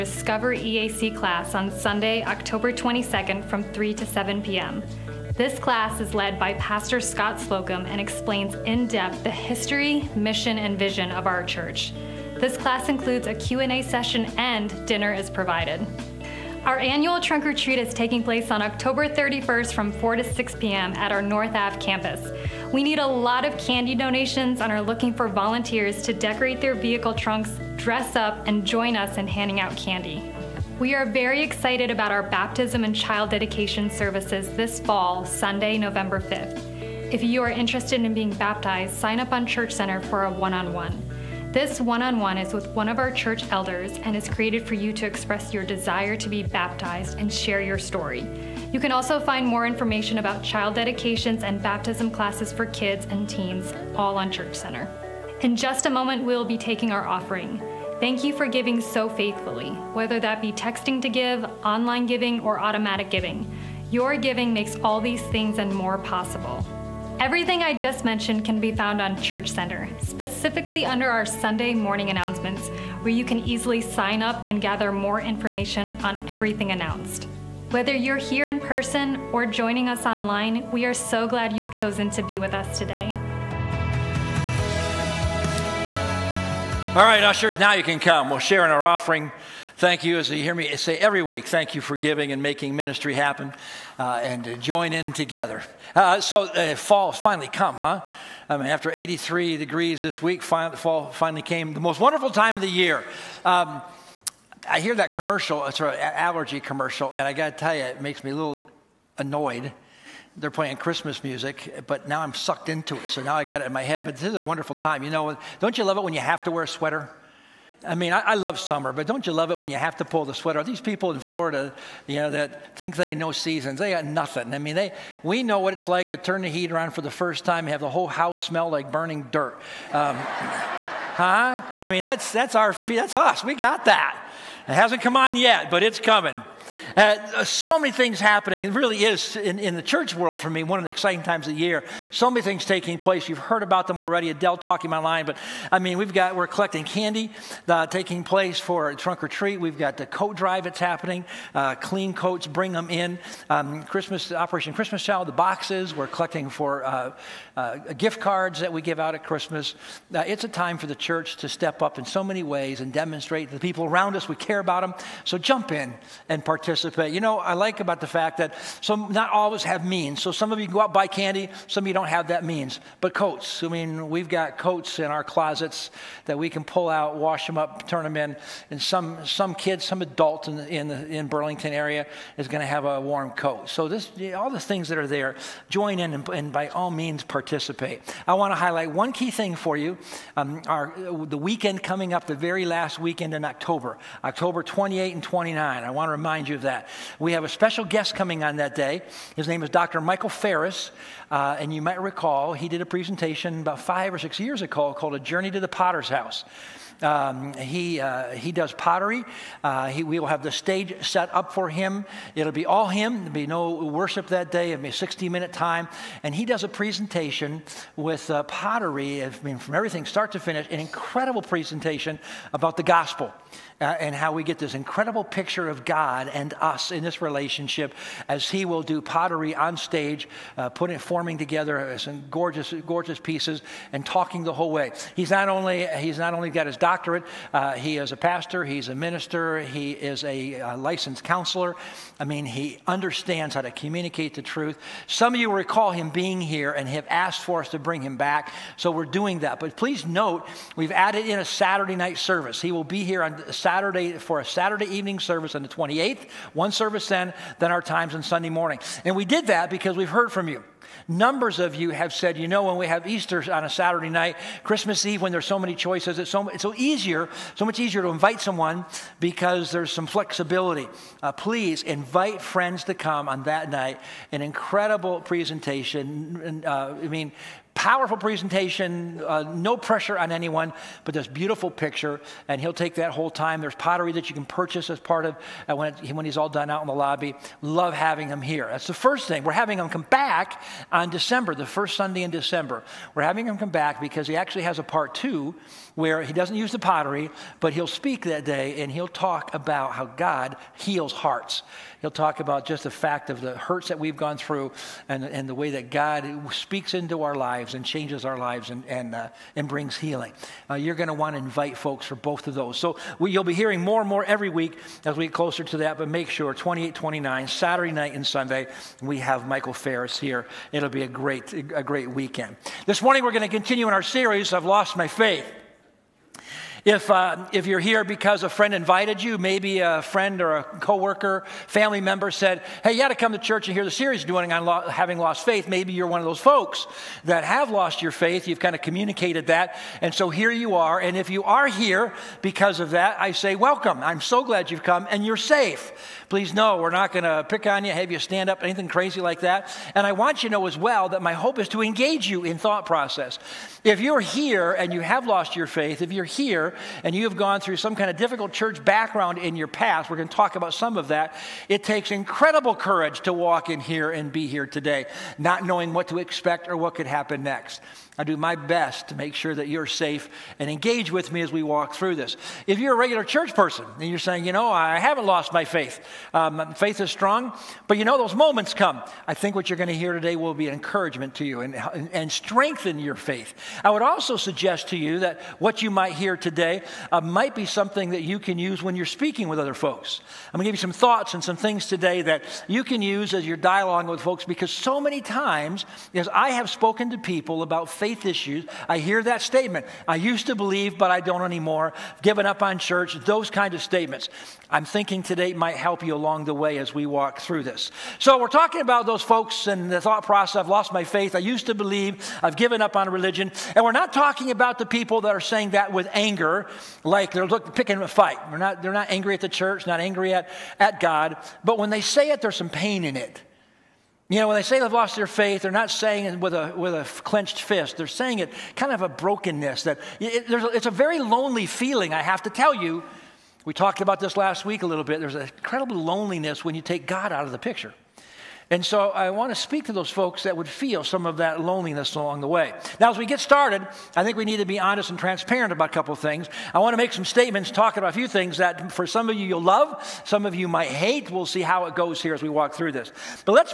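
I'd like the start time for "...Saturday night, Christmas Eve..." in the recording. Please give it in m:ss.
4:23.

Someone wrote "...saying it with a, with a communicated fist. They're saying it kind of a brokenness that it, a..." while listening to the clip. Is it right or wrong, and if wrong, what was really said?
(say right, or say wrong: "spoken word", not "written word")
wrong: "clenched", not "communicated".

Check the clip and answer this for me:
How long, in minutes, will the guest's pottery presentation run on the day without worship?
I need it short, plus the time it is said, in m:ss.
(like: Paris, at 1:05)
60, at 3:34.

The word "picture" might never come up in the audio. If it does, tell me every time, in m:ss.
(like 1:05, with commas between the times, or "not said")
3:45, 4:41, 7:17.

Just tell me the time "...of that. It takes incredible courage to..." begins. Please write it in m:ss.
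6:00.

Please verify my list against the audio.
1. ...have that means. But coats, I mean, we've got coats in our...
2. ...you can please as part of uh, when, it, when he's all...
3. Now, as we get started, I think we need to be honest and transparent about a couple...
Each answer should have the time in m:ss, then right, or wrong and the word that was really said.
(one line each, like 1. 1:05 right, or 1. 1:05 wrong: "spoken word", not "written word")
1. 2:52 right
2. 4:44 wrong: "purchase", not "please"
3. 7:22 right.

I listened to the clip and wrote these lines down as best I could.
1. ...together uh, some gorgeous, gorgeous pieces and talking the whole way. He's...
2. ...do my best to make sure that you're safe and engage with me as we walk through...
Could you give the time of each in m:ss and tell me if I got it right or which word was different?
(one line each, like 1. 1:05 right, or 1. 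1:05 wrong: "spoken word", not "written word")
1. 3:51 right
2. 6:08 right.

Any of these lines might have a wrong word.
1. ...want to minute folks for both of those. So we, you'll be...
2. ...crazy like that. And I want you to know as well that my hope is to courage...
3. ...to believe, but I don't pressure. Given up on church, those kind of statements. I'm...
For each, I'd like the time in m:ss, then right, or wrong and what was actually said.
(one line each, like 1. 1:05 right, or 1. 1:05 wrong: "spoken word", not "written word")
1. 5:11 wrong: "invite", not "minute"
2. 5:48 wrong: "engage", not "courage"
3. 6:40 wrong: "anymore", not "pressure".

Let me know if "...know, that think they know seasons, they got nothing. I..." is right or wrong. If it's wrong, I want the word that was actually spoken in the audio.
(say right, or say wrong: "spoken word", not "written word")
right.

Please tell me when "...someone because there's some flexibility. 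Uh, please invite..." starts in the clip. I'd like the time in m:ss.
4:28.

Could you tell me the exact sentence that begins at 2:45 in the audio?
So jump in and participate participate.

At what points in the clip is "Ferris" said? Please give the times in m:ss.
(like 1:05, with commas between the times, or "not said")
3:20, 5:19.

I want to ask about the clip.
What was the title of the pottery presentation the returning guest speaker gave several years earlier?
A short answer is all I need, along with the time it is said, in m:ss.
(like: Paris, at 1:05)
A Journey to the Potter's House, at 3:25.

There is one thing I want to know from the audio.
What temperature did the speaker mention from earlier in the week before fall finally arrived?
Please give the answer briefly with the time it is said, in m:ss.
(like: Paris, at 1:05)
83 degrees, at 1:38.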